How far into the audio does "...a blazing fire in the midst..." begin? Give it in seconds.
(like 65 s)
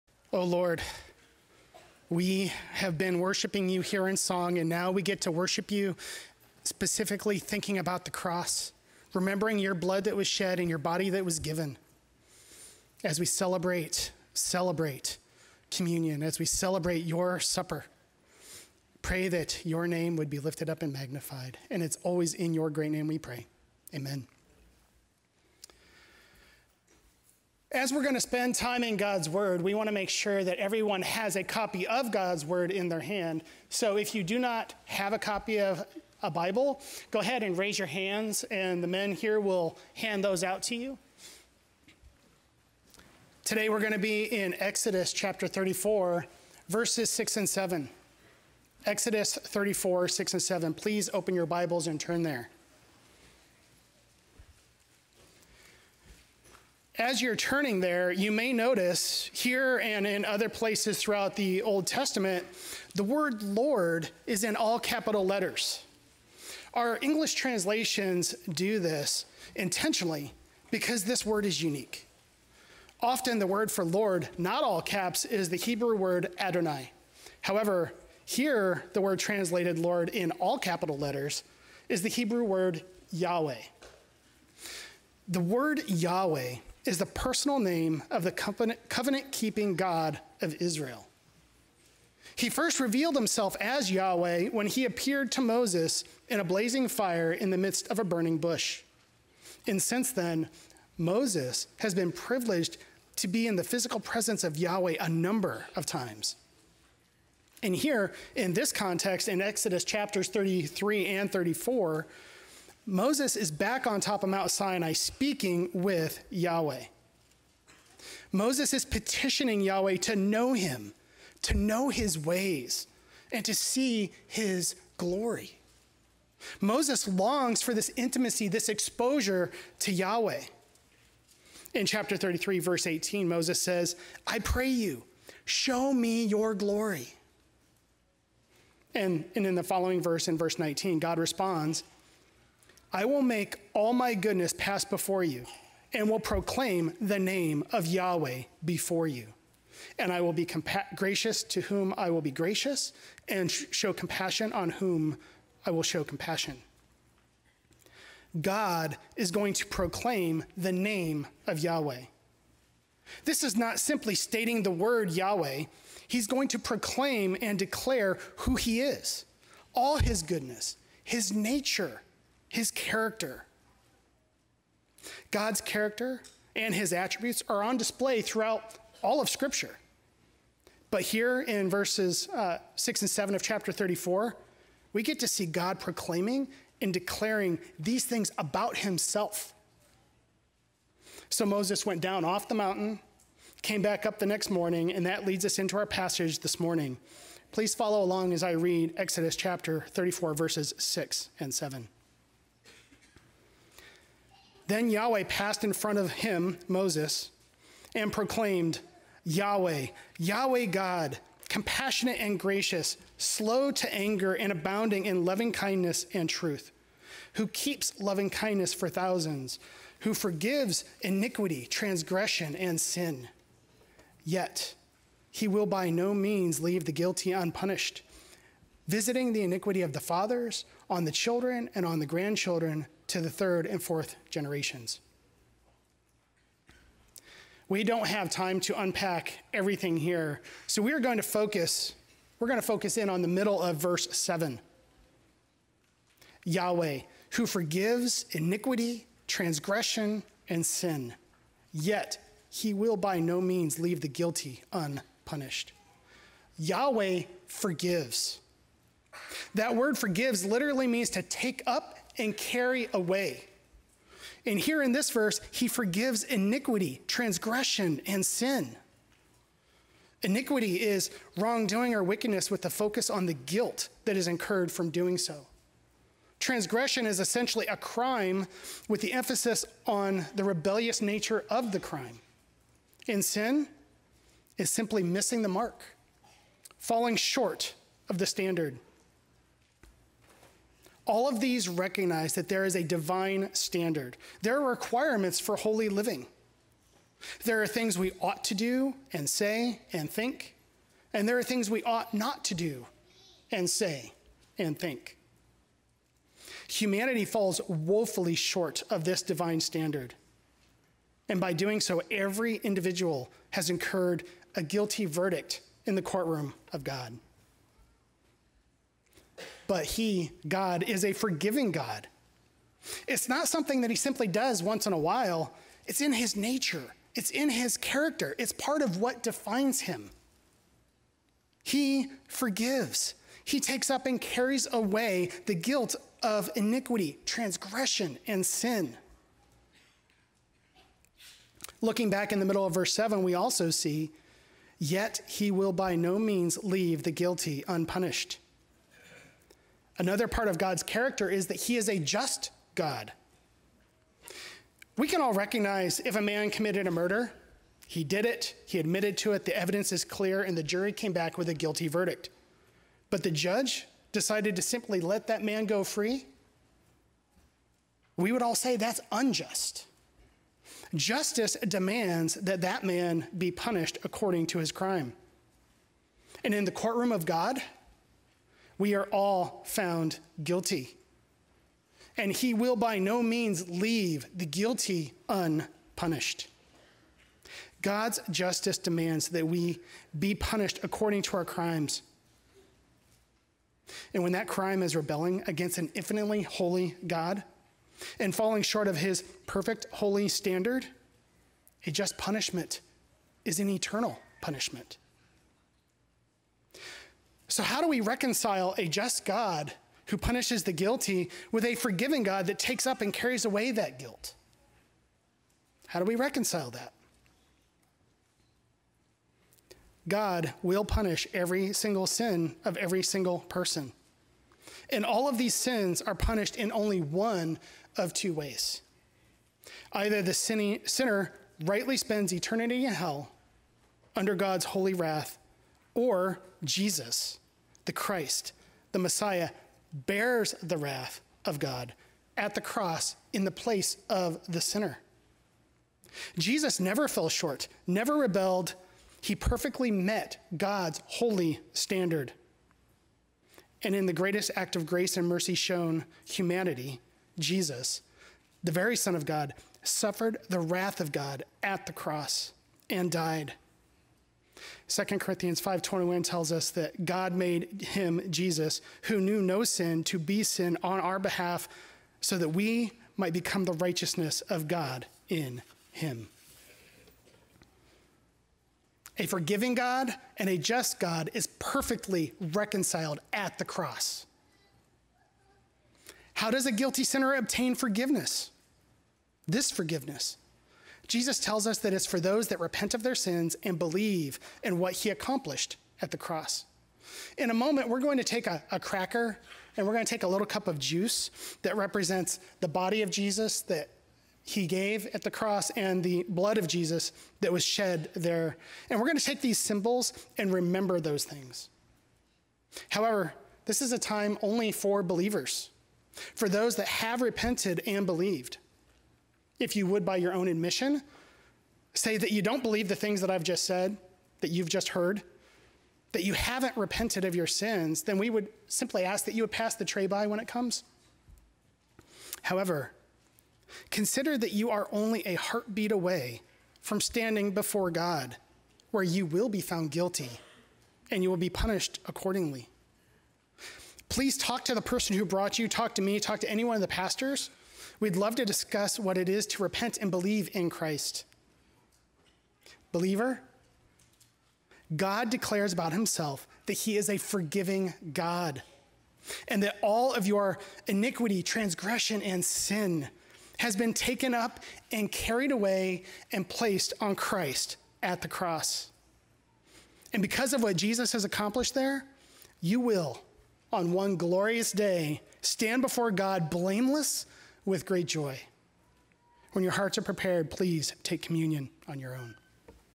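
96 s.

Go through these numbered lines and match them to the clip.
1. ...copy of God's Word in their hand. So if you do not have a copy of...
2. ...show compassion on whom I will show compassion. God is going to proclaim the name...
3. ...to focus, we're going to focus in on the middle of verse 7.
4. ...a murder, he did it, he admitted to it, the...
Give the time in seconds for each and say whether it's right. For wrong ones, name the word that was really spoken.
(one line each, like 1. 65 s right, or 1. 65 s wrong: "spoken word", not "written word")
1. 31 s right
2. 153 s right
3. 241 s right
4. 356 s right.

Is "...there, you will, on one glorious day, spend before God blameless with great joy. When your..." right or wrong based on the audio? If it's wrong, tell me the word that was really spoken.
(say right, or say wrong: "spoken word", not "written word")
wrong: "stand", not "spend".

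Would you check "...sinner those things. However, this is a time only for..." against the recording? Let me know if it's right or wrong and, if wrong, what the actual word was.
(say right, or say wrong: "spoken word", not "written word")
wrong: "remember", not "sinner".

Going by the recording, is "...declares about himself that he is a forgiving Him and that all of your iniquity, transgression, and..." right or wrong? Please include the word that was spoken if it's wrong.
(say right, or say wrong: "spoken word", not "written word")
wrong: "God", not "Him".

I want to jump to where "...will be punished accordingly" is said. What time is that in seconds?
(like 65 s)
541 s.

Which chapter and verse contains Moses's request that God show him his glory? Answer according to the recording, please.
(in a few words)
Chapter 33, verse 18.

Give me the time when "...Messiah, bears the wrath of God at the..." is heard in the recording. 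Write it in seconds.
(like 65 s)
438 s.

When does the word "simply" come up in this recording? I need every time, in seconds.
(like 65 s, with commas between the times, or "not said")
163 s, 284 s, 323 s, 364 s, 528 s.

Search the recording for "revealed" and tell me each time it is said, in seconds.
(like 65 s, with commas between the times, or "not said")
92 s.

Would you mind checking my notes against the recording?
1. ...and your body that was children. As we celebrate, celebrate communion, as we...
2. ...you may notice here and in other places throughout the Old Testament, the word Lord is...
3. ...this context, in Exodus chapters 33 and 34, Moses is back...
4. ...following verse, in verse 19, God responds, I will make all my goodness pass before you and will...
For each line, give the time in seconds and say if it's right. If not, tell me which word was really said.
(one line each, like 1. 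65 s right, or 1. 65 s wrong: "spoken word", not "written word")
1. 10 s wrong: "given", not "children"
2. 58 s right
3. 108 s right
4. 139 s right.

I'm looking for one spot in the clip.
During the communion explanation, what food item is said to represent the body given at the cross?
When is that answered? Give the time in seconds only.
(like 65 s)
498 s.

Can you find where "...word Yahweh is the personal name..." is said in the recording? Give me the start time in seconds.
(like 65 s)
85 s.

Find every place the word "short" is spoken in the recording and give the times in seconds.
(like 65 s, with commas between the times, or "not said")
287 s, 308 s, 398 s, 447 s.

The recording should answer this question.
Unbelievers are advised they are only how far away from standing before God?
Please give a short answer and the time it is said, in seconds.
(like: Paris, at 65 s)
a heartbeat, at 535 s.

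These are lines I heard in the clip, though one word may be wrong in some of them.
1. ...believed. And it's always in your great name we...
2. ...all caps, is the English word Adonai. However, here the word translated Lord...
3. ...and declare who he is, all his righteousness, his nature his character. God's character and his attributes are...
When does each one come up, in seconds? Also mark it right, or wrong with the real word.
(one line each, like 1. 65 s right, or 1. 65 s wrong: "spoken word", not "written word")
1. 20 s wrong: "magnified", not "believed"
2. 74 s wrong: "Hebrew", not "English"
3. 167 s wrong: "goodness", not "righteousness".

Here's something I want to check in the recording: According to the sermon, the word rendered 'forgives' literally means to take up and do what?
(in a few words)
carry away.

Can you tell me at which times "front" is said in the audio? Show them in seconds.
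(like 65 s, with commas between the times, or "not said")
205 s.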